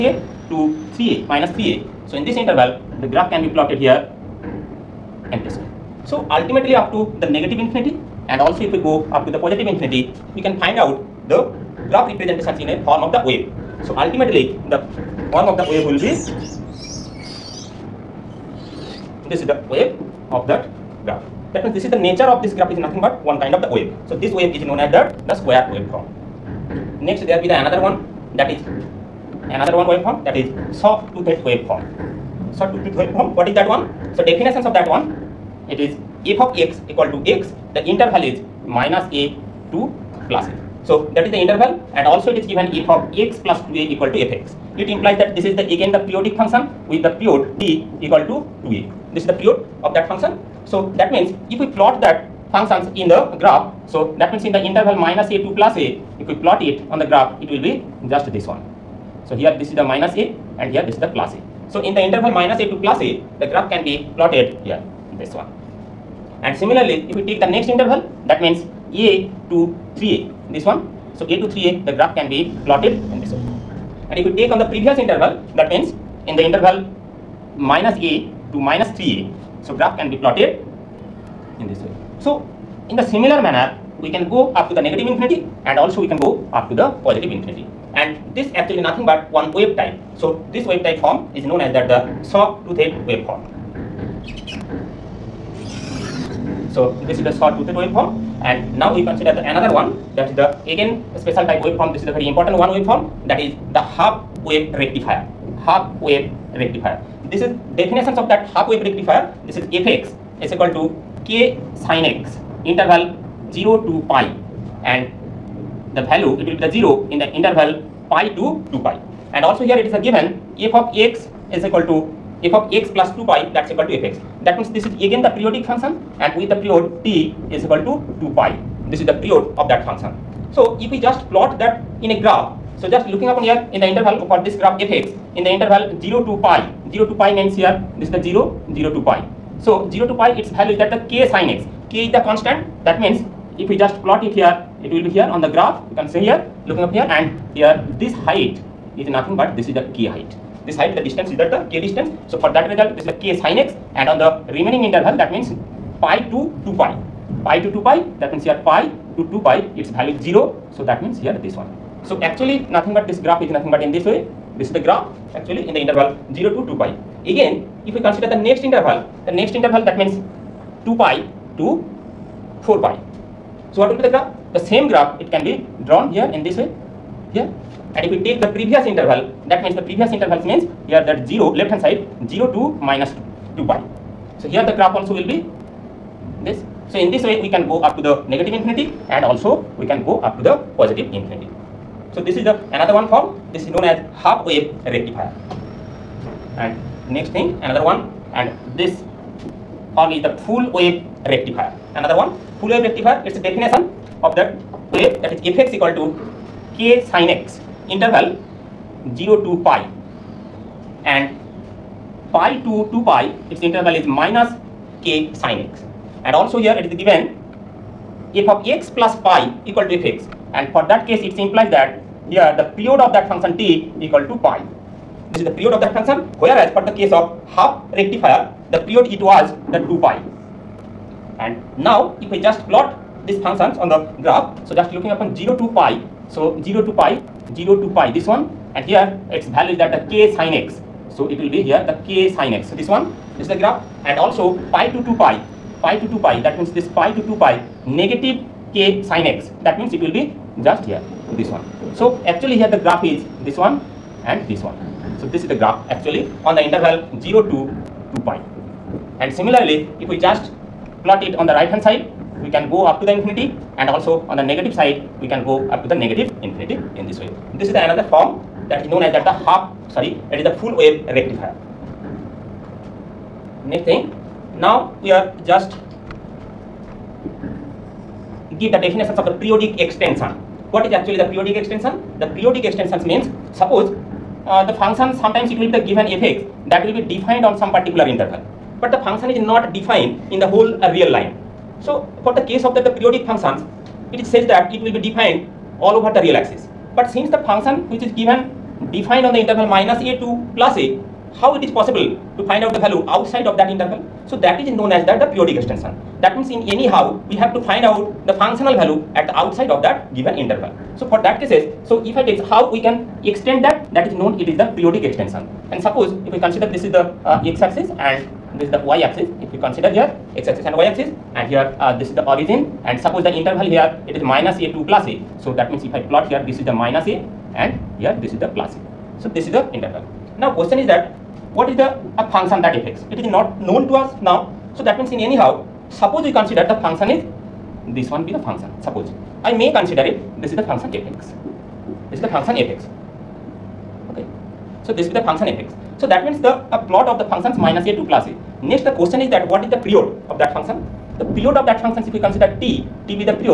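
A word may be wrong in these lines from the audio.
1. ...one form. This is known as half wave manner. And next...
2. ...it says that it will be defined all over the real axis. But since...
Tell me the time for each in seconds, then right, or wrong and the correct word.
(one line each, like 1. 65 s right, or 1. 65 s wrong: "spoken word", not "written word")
1. 192 s wrong: "rectifier", not "manner"
2. 294 s right.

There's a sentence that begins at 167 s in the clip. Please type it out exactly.
Again, if we consider the next interval, the next interval that means 2 pi to 4 pi.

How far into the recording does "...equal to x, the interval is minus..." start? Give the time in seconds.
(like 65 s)
36 s.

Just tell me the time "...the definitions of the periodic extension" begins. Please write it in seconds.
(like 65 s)
278 s.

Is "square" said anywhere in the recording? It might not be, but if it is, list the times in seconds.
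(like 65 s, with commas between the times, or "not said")
25 s.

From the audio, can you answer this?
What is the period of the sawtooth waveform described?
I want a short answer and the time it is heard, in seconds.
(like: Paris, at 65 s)
2a, at 47 s.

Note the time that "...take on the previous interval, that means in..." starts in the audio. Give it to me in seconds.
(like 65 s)
74 s.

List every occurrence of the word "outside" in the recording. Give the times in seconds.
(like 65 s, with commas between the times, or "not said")
303 s, 309 s.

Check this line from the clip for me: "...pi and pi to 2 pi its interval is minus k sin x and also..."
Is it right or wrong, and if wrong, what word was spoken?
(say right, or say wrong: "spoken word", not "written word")
right.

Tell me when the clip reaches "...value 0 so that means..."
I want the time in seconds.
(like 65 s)
159 s.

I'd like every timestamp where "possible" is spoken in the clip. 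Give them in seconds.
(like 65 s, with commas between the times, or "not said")
301 s.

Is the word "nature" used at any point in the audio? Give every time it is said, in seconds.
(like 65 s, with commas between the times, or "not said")
21 s.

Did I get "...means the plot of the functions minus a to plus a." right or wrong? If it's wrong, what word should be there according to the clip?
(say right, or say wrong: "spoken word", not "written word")
right.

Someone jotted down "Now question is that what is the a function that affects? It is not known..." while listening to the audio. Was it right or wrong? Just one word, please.
right.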